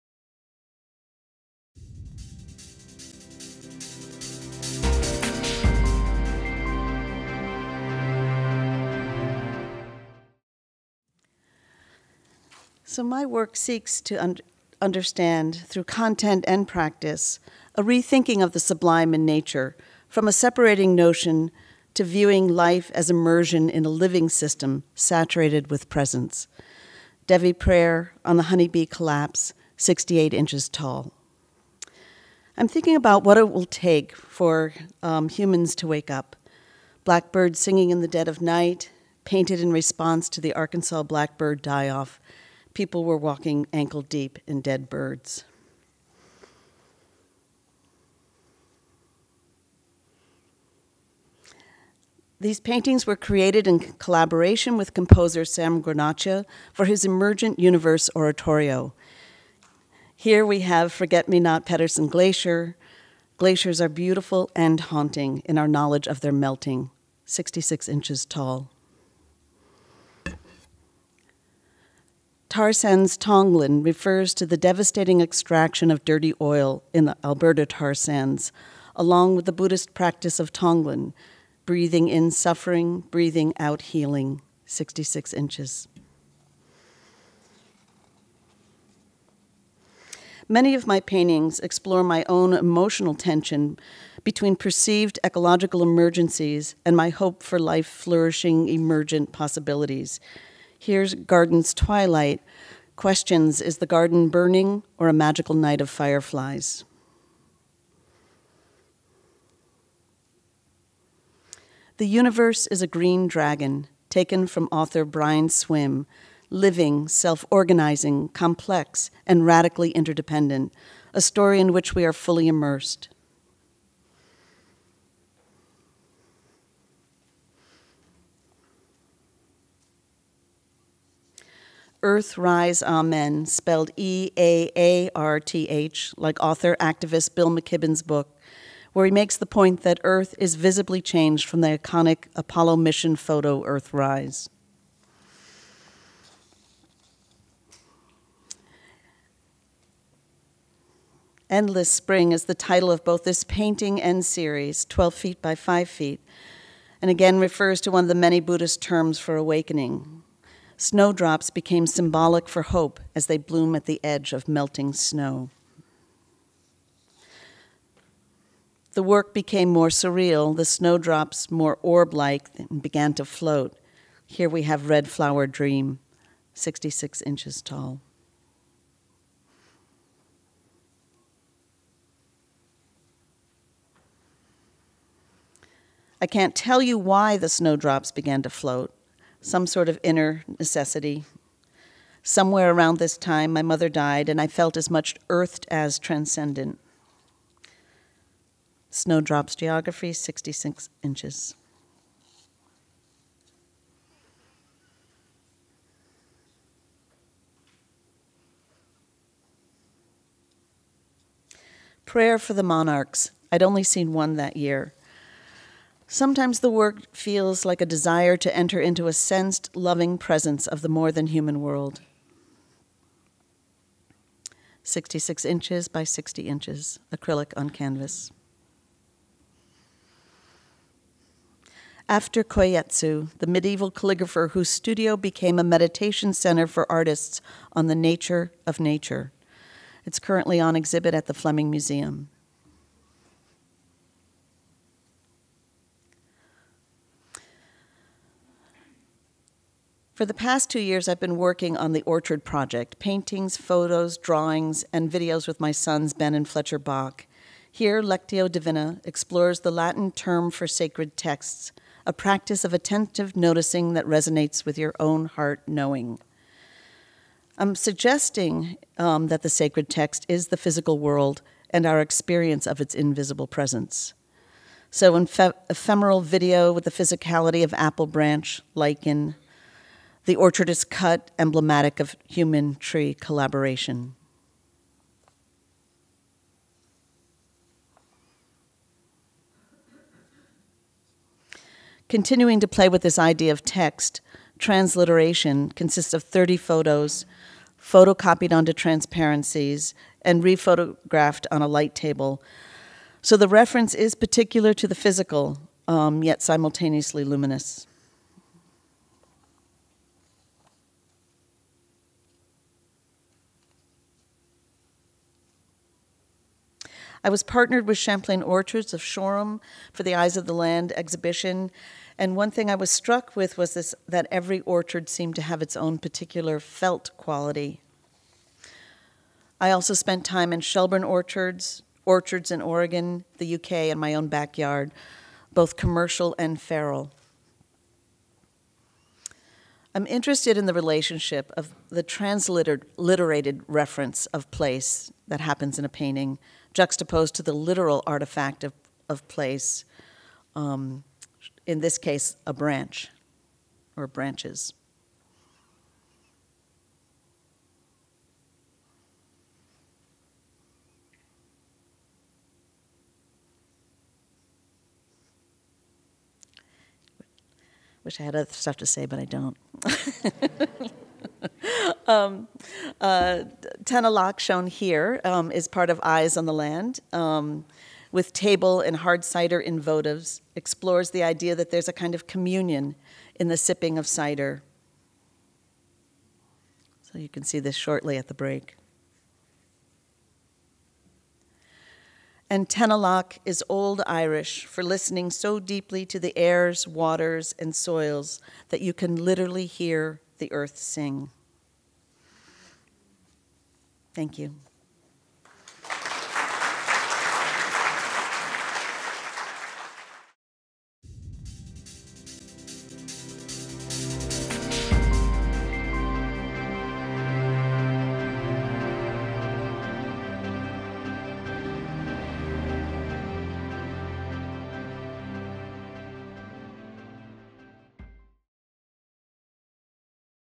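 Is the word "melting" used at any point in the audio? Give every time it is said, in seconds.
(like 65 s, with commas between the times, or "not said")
66 s, 164 s.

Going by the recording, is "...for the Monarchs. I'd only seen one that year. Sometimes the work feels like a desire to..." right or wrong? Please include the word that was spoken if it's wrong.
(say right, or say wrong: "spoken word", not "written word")
right.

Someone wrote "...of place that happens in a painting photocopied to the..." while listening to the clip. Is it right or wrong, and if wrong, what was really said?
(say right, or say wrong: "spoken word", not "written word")
wrong: "juxtaposed", not "photocopied".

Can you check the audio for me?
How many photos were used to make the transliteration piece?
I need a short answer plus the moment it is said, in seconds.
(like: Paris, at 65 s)
30, at 296 s.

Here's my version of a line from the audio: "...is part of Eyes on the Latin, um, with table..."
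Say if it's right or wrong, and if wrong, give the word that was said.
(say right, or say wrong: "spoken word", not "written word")
wrong: "Land", not "Latin".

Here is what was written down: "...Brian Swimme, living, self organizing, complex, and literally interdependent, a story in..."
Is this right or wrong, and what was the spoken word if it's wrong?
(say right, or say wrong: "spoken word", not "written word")
wrong: "radically", not "literally".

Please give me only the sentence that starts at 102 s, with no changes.
Questions Is the garden burning or a magical night of fireflies?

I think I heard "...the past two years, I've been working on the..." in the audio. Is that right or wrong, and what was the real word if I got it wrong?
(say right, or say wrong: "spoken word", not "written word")
right.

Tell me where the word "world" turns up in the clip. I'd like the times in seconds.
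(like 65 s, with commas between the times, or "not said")
221 s, 270 s.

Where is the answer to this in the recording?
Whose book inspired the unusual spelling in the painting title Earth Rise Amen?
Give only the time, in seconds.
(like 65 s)
137 s.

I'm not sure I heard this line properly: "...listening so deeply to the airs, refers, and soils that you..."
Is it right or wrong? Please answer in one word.
wrong.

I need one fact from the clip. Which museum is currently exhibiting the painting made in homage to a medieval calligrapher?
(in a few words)
Fleming Museum.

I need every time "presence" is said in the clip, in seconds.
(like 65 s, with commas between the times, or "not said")
25 s, 220 s, 273 s.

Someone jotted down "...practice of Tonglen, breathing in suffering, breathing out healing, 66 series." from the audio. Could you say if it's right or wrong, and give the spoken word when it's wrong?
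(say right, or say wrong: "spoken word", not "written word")
wrong: "inches", not "series".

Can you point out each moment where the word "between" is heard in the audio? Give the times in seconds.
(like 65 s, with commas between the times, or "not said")
94 s.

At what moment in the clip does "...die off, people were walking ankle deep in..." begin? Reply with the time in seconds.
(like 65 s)
41 s.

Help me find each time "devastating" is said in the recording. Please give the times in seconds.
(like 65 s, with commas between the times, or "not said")
74 s.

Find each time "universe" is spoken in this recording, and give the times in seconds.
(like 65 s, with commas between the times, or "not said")
57 s, 112 s.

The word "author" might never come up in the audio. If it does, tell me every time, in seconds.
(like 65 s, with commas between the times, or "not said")
114 s, 136 s.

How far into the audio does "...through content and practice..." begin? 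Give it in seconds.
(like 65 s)
15 s.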